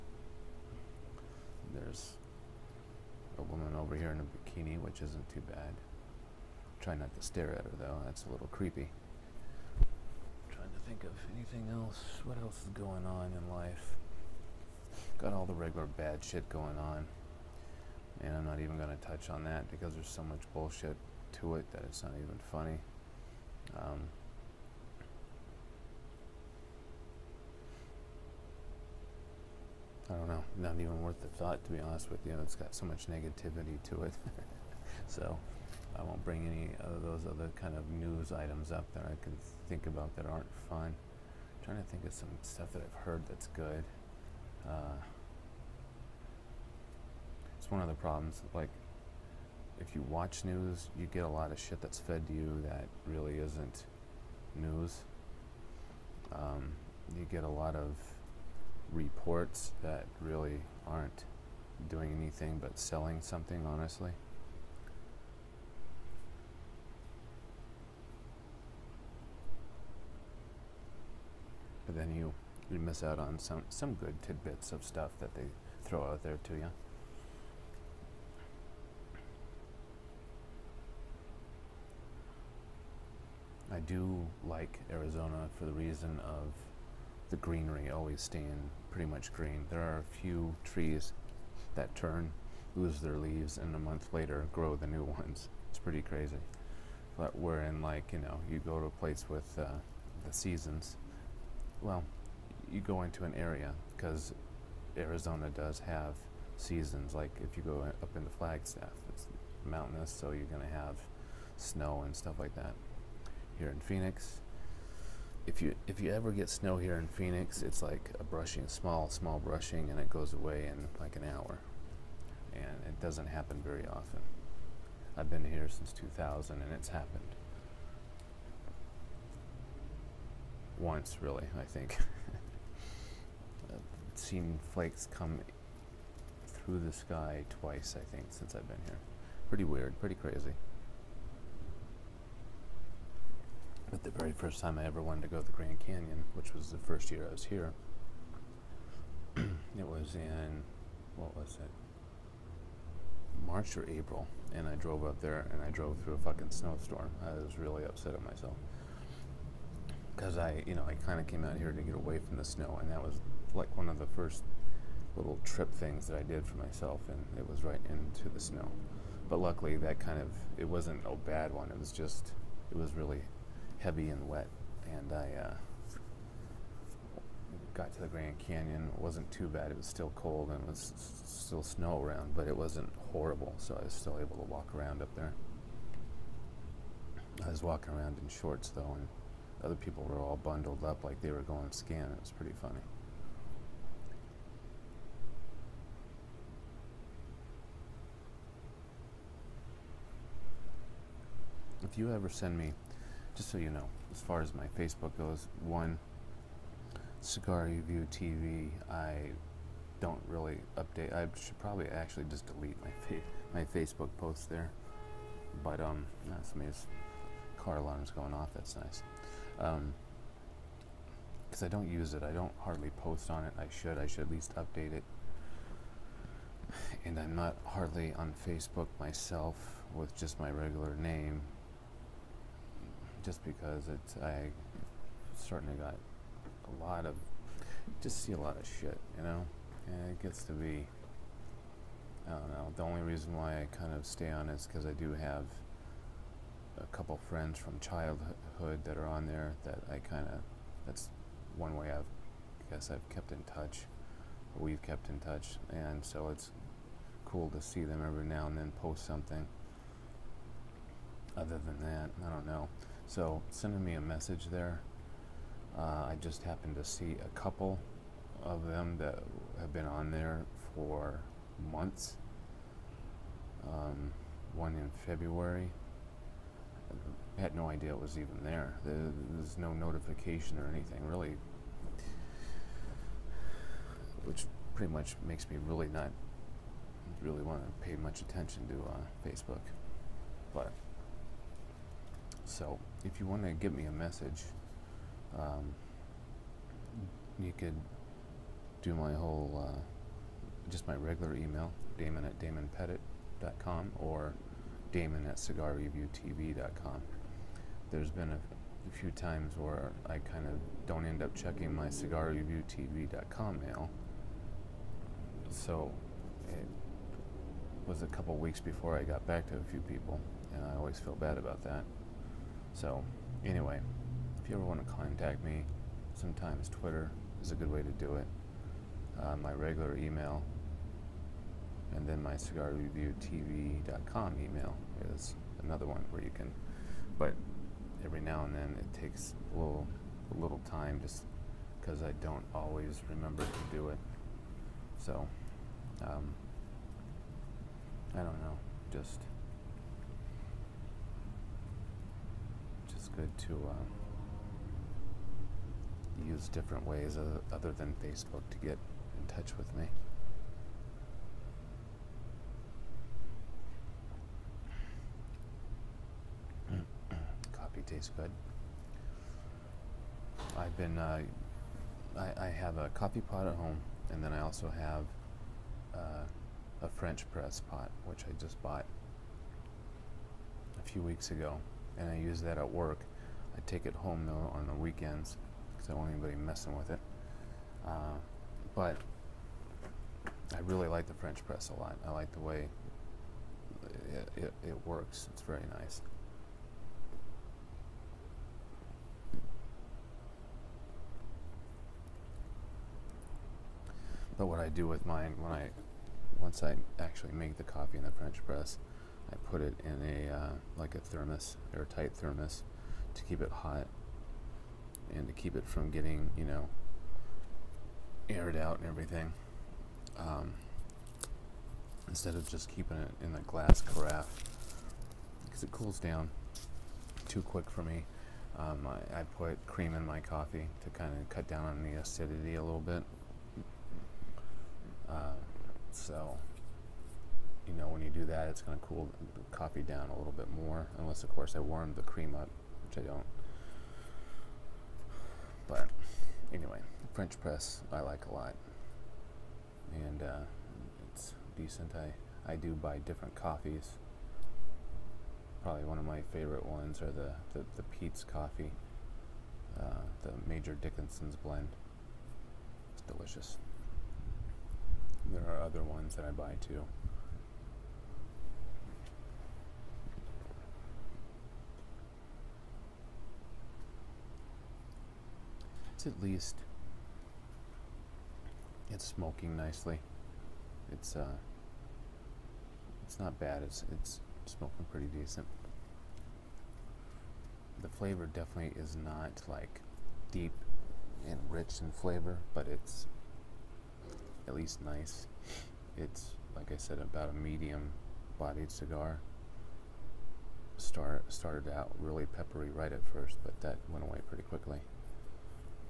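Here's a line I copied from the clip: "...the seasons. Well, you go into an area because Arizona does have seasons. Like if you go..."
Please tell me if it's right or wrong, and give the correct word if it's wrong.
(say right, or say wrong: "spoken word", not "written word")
right.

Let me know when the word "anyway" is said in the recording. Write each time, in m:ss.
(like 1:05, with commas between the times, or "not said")
5:23, 7:26.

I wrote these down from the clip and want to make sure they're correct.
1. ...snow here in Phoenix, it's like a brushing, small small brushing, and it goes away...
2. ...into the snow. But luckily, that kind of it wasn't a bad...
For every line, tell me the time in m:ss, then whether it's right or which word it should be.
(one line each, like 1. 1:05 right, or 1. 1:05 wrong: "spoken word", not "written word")
1. 1:56 right
2. 2:47 right.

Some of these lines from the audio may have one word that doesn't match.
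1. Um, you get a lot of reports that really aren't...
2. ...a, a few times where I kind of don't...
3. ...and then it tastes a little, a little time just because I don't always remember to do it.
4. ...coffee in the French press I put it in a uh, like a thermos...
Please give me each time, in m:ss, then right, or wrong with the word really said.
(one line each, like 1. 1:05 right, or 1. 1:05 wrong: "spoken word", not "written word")
1. 0:56 right
2. 5:08 right
3. 5:38 wrong: "takes", not "tastes"
4. 6:47 right.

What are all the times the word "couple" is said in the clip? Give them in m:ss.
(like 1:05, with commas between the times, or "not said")
4:06, 4:27, 5:18.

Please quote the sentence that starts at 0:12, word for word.
What else is going on in life?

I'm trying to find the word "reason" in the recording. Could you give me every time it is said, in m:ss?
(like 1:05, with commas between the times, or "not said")
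1:25, 4:03.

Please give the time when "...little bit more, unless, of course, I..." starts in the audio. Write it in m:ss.
7:20.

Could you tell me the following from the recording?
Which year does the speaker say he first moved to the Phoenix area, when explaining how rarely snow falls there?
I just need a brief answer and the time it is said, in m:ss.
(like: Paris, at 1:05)
2000, at 2:05.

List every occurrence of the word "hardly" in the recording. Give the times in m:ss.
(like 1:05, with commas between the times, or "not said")
3:42, 3:47.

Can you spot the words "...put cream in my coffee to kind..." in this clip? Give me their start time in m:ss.
7:09.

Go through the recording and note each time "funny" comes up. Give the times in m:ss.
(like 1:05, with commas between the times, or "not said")
0:22, 3:12.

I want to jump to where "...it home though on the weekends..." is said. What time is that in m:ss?
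6:23.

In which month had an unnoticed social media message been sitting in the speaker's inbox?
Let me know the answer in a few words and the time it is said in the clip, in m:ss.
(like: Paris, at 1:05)
February, at 4:35.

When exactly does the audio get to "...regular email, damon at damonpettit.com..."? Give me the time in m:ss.
5:00.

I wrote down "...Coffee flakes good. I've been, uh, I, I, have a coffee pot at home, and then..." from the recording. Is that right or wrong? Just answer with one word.
wrong.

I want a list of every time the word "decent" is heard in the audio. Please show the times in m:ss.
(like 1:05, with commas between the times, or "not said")
7:31, 8:05.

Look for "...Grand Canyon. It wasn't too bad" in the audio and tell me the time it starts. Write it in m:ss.
2:58.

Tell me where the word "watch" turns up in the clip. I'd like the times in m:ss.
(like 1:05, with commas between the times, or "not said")
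0:50.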